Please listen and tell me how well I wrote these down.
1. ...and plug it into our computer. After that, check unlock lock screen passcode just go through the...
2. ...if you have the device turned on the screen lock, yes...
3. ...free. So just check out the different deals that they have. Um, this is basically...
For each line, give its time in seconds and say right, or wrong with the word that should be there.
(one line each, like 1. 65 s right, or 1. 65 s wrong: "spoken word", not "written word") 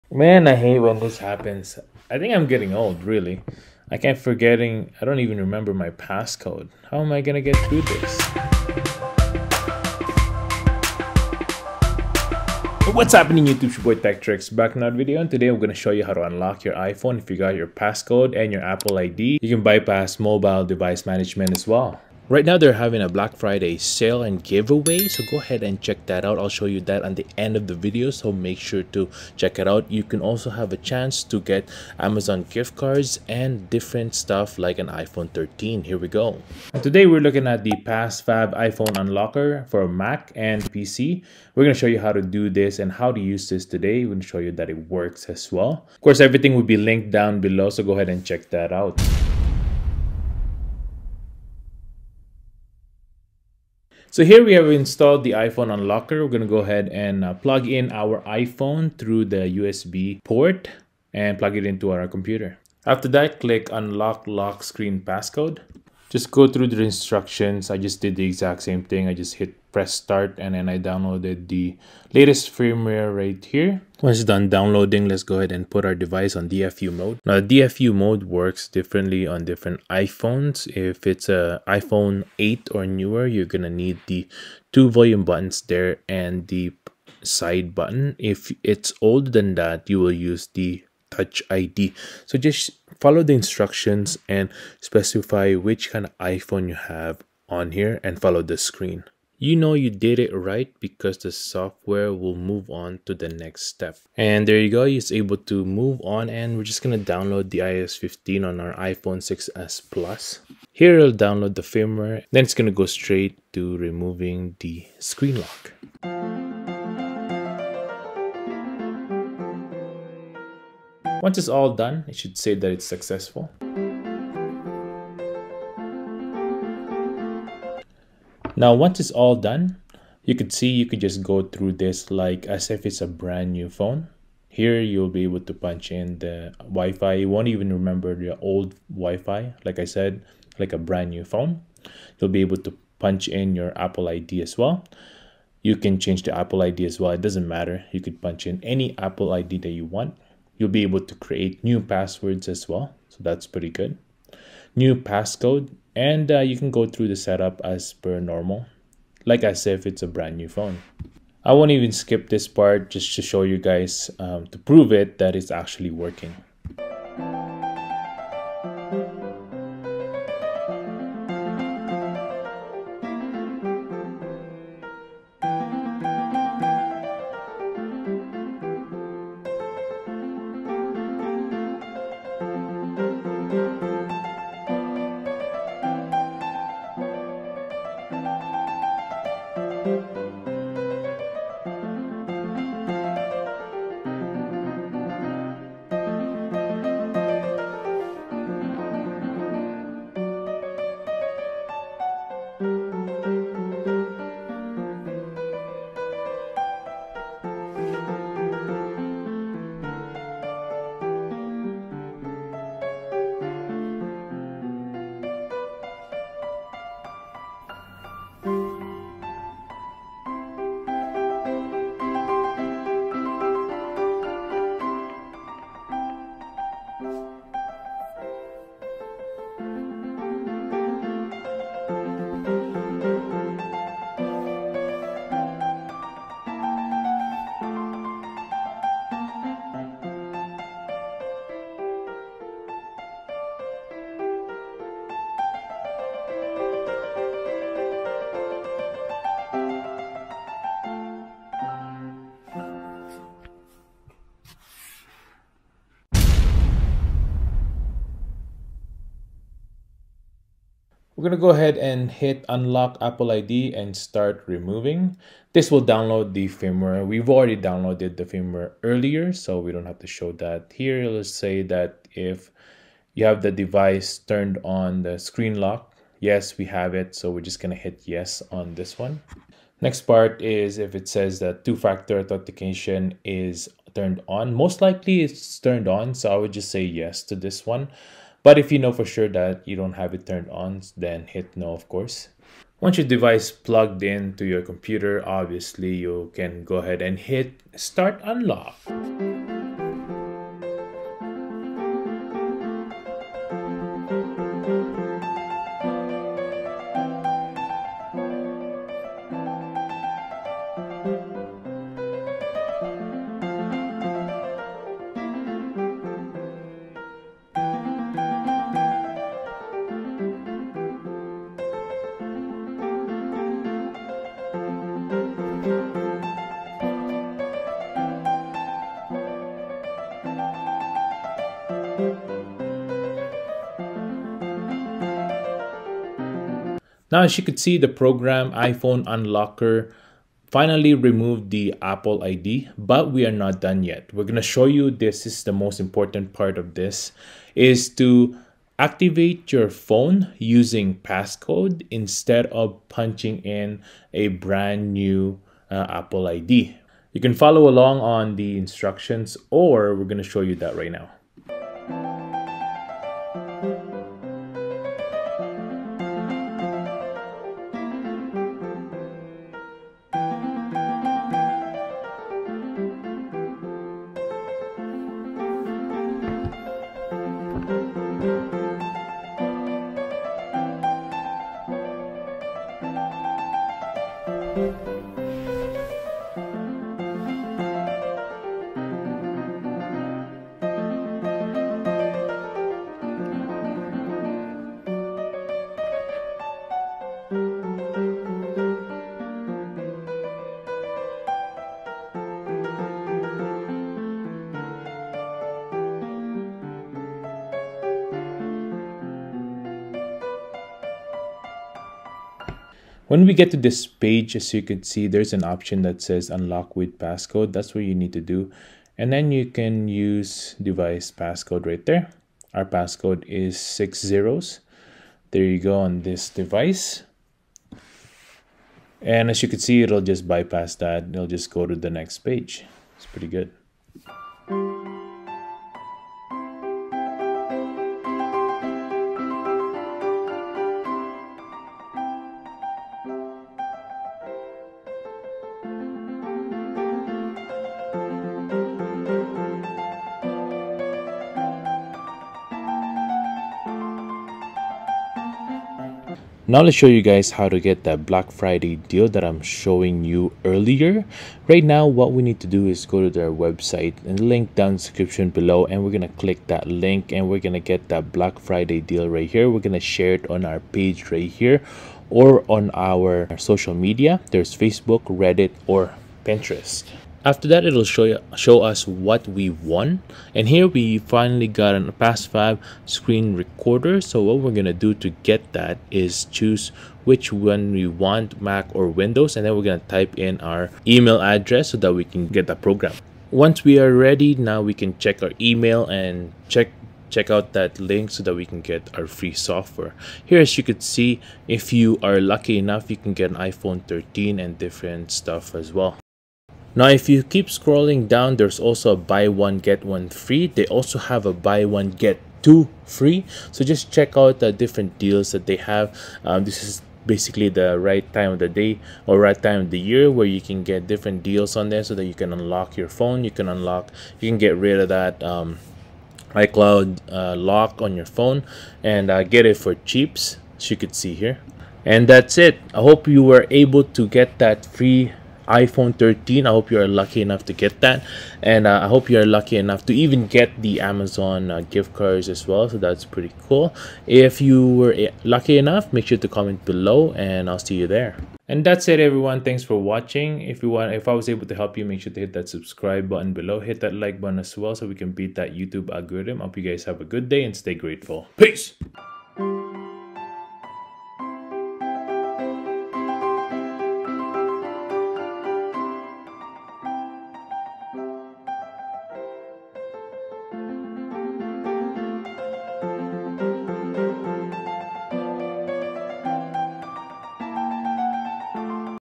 1. 61 s wrong: "click", not "check"
2. 272 s right
3. 512 s right.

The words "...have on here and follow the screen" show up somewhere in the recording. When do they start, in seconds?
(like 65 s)
96 s.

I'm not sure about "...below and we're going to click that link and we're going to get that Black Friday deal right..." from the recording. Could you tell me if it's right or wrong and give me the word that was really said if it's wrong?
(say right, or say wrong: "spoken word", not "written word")
right.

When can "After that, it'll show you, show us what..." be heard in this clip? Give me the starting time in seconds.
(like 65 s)
477 s.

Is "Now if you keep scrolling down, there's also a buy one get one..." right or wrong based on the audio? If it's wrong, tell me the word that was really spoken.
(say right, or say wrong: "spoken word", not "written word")
right.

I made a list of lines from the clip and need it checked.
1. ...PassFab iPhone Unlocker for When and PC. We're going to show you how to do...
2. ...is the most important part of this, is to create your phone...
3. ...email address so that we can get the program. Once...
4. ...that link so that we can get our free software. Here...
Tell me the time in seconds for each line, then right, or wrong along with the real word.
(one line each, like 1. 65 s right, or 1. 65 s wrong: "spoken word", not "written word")
1. 37 s wrong: "Mac", not "When"
2. 345 s wrong: "activate", not "create"
3. 490 s right
4. 497 s right.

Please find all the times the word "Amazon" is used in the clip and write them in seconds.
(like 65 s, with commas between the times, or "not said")
31 s, 540 s.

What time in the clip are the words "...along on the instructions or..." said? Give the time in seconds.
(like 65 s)
357 s.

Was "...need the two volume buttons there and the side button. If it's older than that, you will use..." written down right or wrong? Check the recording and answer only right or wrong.
right.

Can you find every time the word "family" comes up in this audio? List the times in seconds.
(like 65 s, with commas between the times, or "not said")
not said.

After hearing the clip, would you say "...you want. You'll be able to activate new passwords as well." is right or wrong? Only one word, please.
wrong.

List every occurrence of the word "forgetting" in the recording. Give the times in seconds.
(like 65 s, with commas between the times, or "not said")
4 s.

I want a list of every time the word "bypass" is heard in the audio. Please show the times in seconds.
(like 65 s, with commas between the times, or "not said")
19 s, 430 s.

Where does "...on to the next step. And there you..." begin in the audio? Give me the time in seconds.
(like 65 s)
102 s.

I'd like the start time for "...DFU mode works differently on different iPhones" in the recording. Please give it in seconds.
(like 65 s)
77 s.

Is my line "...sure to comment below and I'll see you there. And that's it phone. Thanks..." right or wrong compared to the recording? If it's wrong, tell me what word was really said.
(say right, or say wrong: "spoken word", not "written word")
wrong: "everyone", not "phone".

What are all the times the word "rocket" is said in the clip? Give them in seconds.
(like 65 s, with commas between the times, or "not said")
not said.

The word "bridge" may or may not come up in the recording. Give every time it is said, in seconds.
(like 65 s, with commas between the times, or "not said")
not said.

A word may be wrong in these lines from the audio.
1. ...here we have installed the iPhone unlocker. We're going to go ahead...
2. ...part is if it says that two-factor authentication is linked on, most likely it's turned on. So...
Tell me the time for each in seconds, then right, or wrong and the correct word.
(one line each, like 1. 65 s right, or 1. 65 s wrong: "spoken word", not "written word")
1. 54 s right
2. 280 s wrong: "turned", not "linked".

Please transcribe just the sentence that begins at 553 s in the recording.
Hit that like button as well so we can beat that YouTube algorithm.